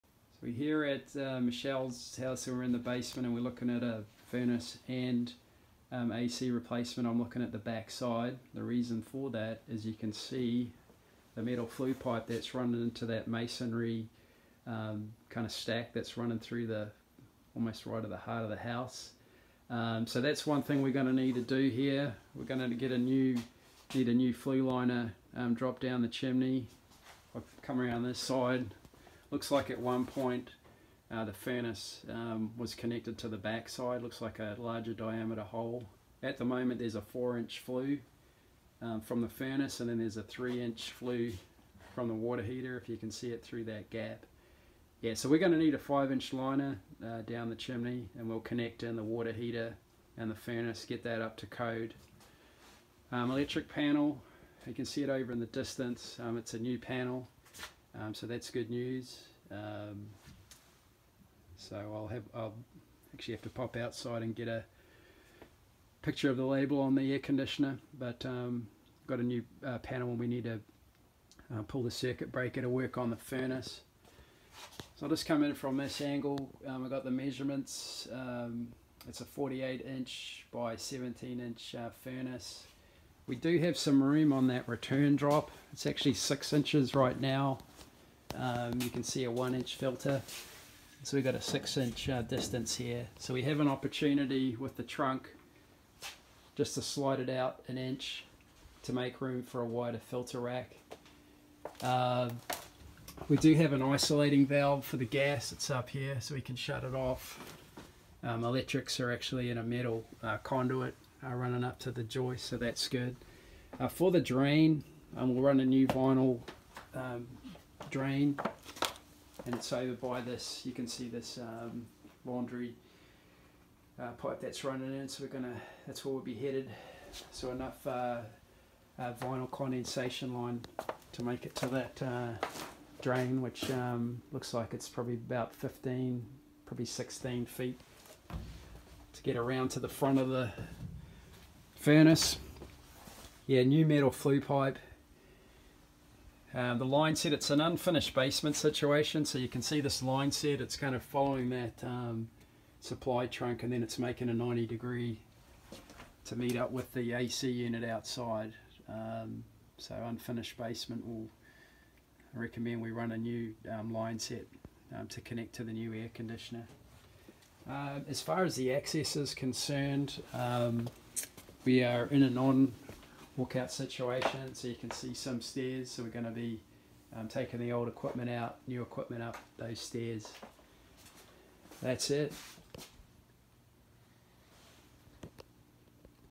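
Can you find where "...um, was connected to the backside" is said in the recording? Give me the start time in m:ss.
0:32.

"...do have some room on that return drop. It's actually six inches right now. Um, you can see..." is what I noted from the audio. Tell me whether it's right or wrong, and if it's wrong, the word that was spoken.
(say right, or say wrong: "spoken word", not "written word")
right.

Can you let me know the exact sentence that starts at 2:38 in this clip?
Um, so unfinished basement will recommend we run a new um, line set um, to connect to the new air conditioner.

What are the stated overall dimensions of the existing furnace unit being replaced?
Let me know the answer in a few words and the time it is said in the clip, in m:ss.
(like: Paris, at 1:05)
48 inch by 17 inch, at 1:19.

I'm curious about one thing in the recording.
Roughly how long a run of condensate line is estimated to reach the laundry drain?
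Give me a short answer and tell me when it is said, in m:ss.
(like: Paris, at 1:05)
16 feet, at 2:16.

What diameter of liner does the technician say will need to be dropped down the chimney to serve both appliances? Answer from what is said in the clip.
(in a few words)
5 inch.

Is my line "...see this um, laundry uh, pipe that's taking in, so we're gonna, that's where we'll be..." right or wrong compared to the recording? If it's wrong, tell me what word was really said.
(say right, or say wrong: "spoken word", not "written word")
wrong: "running", not "taking".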